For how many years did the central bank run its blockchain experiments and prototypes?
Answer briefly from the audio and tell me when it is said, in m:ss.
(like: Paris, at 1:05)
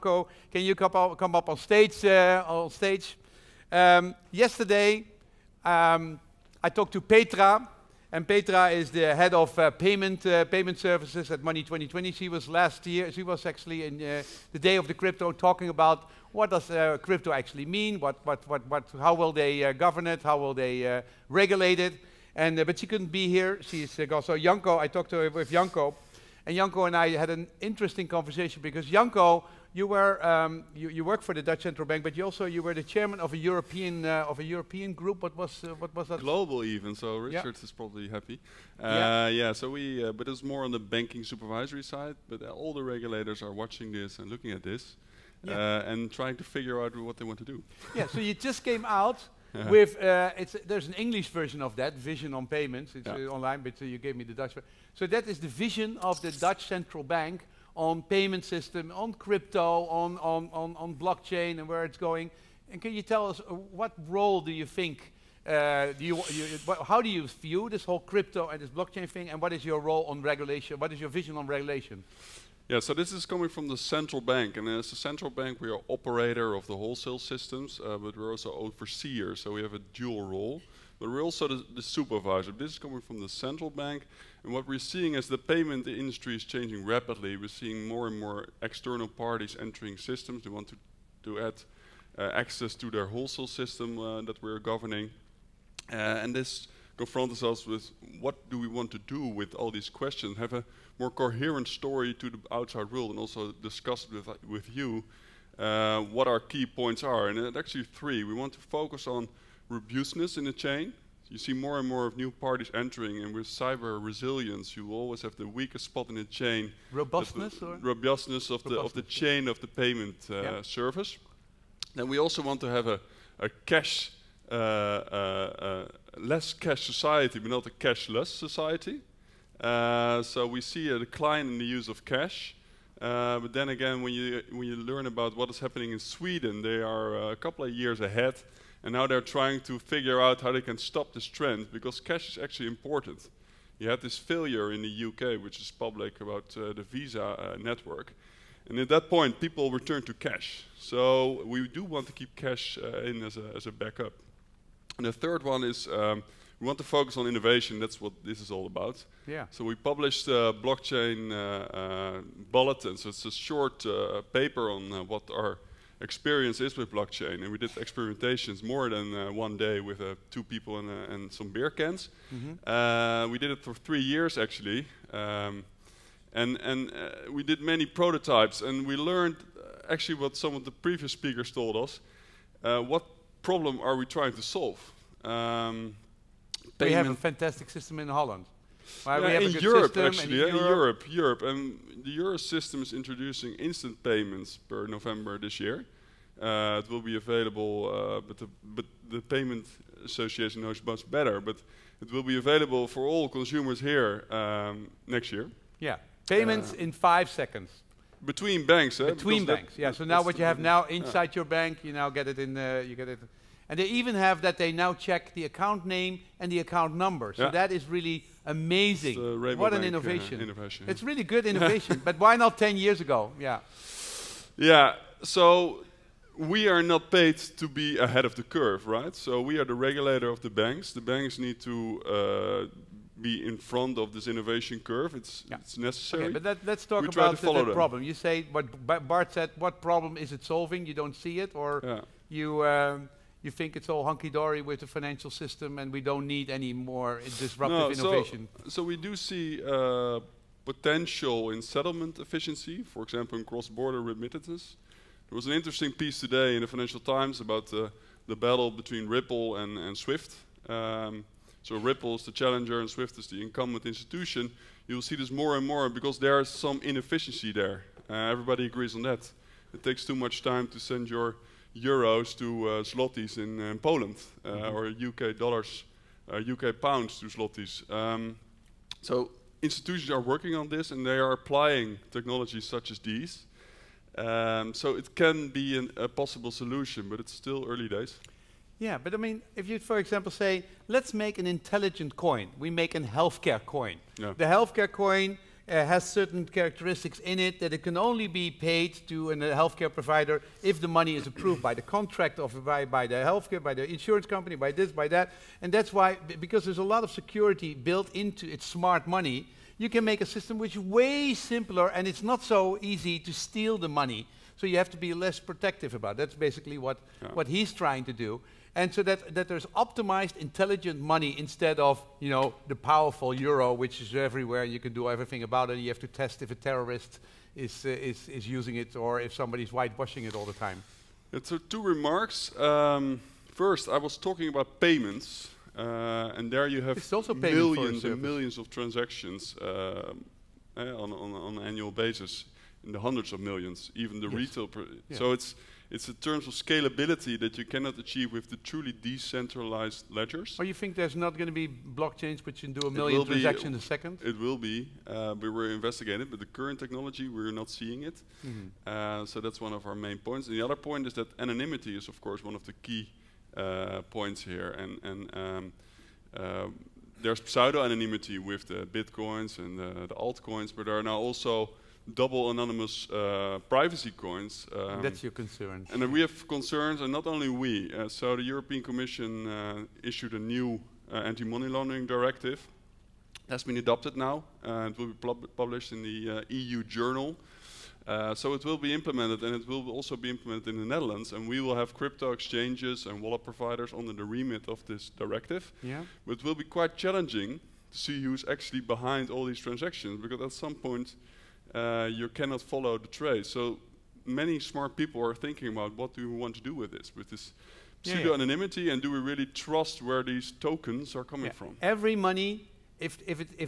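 3, at 2:53.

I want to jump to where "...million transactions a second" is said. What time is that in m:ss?
5:52.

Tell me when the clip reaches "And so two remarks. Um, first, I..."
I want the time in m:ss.
5:31.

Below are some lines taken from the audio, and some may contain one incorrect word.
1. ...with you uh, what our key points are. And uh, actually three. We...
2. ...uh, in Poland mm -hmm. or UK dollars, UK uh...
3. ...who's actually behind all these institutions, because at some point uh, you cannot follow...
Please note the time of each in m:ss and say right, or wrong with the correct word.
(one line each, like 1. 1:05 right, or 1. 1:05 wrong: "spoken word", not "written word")
1. 1:44 right
2. 4:33 right
3. 6:38 wrong: "transactions", not "institutions".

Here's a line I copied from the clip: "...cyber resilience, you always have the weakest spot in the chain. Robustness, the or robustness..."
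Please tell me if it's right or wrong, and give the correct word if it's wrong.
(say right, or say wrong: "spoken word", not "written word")
right.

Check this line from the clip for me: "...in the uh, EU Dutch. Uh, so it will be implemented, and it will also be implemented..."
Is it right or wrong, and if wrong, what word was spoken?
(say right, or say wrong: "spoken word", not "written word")
wrong: "Journal", not "Dutch".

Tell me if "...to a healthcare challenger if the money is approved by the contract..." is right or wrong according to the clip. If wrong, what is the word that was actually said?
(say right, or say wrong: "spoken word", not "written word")
wrong: "provider", not "challenger".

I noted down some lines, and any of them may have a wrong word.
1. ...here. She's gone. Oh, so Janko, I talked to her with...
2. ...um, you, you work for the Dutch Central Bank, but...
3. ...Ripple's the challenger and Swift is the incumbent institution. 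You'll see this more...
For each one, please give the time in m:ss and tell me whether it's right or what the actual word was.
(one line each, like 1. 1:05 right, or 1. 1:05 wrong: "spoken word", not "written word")
1. 0:23 right
2. 0:30 right
3. 4:21 right.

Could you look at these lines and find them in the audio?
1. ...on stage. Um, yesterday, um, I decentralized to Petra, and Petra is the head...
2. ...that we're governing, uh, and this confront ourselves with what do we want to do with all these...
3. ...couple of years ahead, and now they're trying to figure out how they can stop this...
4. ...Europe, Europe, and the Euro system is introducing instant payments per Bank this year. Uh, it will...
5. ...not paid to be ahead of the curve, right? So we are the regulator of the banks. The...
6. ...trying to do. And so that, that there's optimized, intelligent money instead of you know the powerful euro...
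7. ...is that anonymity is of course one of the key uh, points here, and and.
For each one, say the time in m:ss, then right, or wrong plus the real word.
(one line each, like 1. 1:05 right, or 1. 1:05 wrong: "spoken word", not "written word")
1. 0:02 wrong: "talked", not "decentralized"
2. 1:34 right
3. 2:17 right
4. 3:10 wrong: "November", not "Bank"
5. 3:46 right
6. 5:17 right
7. 6:01 right.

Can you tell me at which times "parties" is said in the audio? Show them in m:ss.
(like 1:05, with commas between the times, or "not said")
1:29, 1:52.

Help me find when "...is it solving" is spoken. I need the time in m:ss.
4:00.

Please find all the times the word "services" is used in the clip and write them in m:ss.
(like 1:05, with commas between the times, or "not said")
0:10, 2:00.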